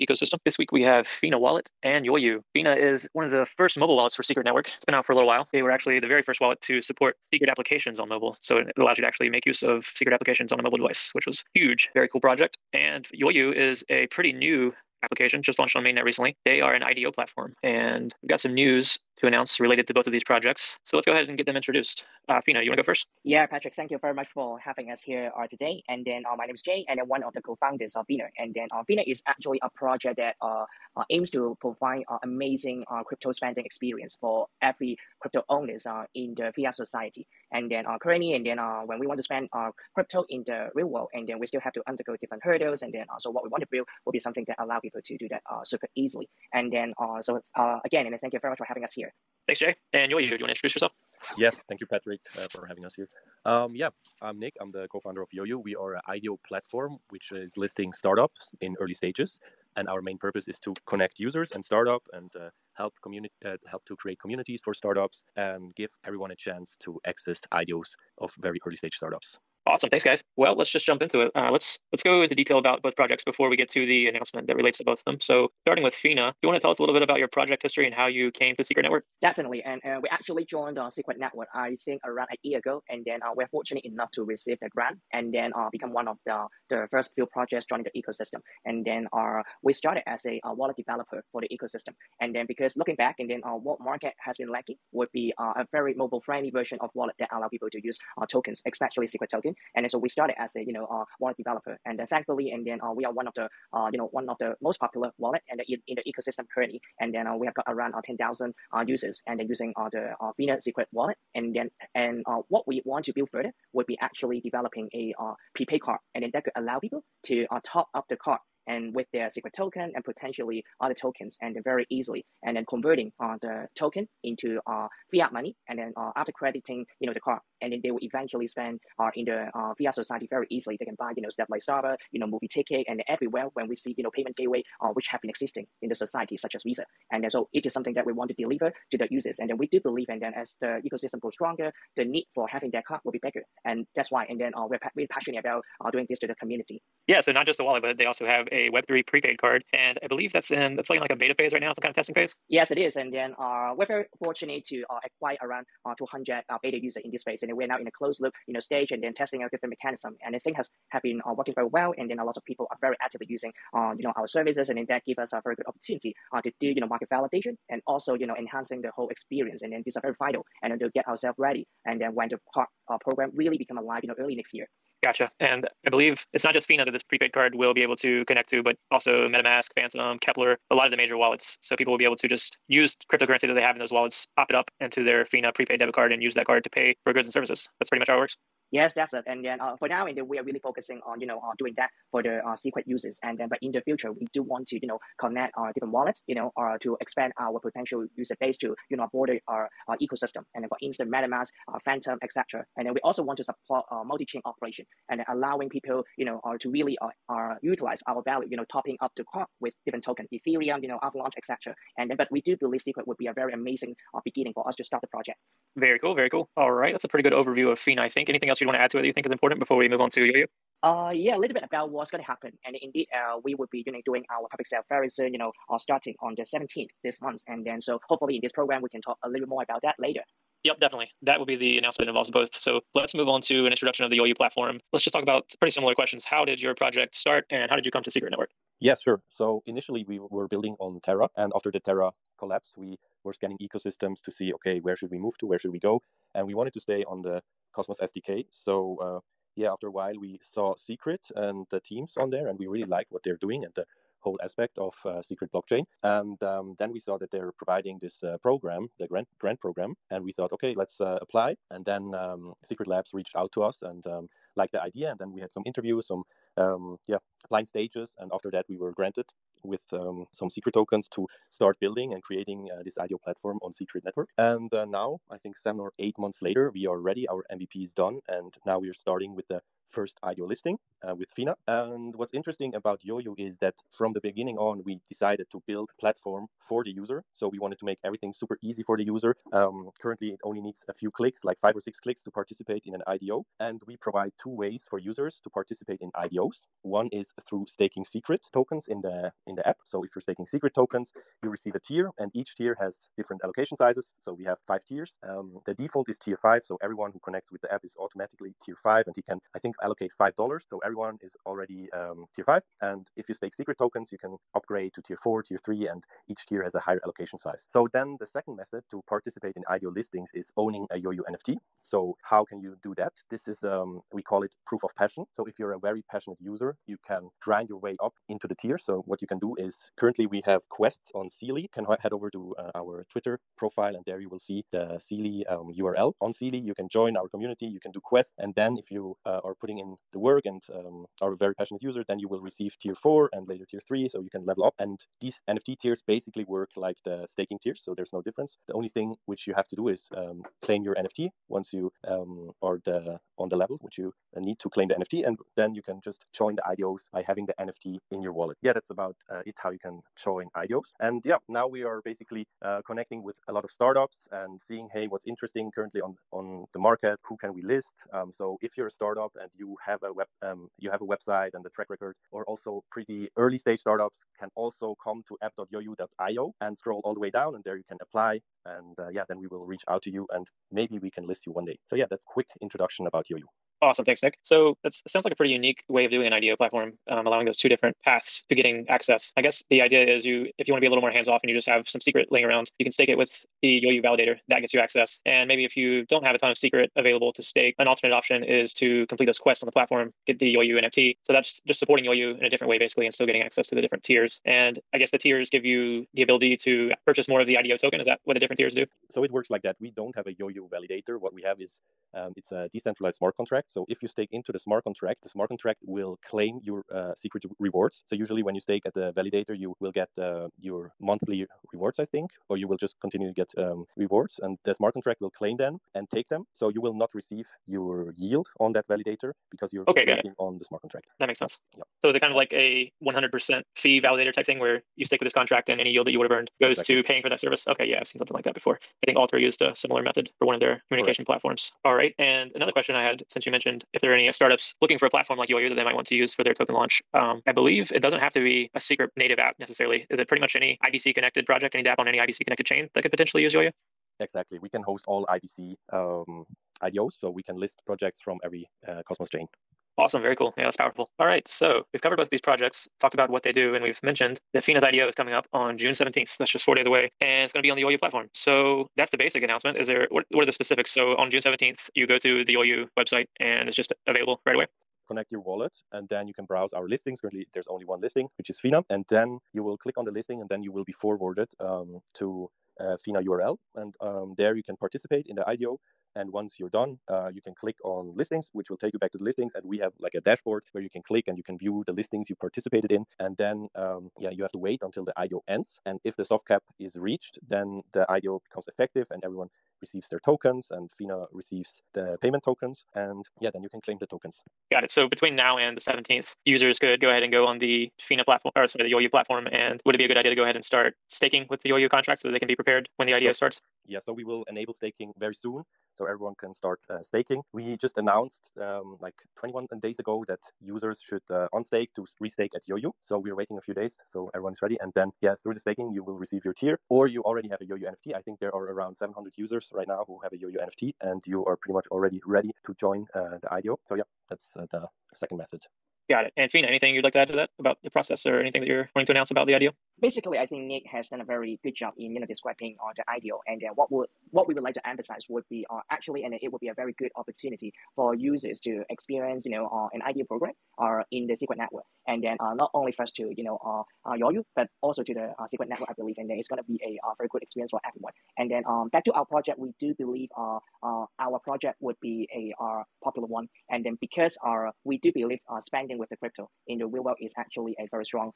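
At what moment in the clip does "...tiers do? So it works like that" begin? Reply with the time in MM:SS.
06:48.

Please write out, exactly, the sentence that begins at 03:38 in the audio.
Anything else you'd want to add to it that you think is important before we move on to Yoyo?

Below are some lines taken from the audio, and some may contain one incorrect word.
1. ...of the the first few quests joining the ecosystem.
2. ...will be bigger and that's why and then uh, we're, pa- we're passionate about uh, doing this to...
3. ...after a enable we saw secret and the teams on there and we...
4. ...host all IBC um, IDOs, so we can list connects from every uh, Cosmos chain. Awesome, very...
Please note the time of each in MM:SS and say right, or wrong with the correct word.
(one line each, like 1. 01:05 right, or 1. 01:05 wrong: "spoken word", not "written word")
1. 01:26 wrong: "projects", not "quests"
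2. 02:23 right
3. 04:09 wrong: "while", not "enable"
4. 07:34 wrong: "projects", not "connects".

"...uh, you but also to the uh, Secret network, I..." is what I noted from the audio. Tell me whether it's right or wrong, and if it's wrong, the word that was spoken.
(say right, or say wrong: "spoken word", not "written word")
right.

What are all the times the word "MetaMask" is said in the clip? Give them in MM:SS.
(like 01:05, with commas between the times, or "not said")
02:59, 03:21.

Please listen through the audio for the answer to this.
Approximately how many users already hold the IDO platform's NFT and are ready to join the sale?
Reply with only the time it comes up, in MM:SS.
08:48.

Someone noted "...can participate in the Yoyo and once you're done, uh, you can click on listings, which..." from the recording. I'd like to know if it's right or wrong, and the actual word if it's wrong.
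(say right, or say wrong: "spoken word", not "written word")
wrong: "IDO", not "Yoyo".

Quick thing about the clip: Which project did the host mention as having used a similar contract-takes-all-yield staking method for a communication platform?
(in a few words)
Alter.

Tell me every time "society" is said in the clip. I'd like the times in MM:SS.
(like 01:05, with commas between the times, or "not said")
00:36, 02:09, 02:15.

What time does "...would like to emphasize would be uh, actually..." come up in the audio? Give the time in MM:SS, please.
09:04.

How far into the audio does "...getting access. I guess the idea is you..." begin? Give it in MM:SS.
06:28.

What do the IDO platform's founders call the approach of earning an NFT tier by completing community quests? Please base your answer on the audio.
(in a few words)
proof of passion.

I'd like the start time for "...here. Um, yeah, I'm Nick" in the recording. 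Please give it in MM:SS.
00:52.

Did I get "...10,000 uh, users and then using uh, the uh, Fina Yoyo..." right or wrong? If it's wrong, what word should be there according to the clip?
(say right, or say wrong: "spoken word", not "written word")
wrong: "Secret", not "Yoyo".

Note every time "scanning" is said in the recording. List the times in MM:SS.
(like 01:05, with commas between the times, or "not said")
04:03.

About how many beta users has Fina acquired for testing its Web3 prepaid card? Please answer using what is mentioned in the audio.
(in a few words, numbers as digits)
200.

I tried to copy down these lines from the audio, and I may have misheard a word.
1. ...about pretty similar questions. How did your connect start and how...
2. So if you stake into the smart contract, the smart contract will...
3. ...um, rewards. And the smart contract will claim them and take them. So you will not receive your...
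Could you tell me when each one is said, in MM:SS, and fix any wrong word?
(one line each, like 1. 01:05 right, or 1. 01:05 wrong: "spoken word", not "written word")
1. 03:55 wrong: "project", not "connect"
2. 06:53 right
3. 07:03 right.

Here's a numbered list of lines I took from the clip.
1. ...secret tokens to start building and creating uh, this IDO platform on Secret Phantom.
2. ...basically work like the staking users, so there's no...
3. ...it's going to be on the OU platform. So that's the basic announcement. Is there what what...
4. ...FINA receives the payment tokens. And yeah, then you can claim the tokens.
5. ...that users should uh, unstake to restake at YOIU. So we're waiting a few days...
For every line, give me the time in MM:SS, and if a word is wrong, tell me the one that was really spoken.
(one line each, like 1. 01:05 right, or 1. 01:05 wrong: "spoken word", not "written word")
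1. 04:30 wrong: "Network", not "Phantom"
2. 05:46 wrong: "tiers", not "users"
3. 07:47 right
4. 08:20 right
5. 08:40 right.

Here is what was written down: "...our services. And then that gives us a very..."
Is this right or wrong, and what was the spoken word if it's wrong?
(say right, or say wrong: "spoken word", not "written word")
right.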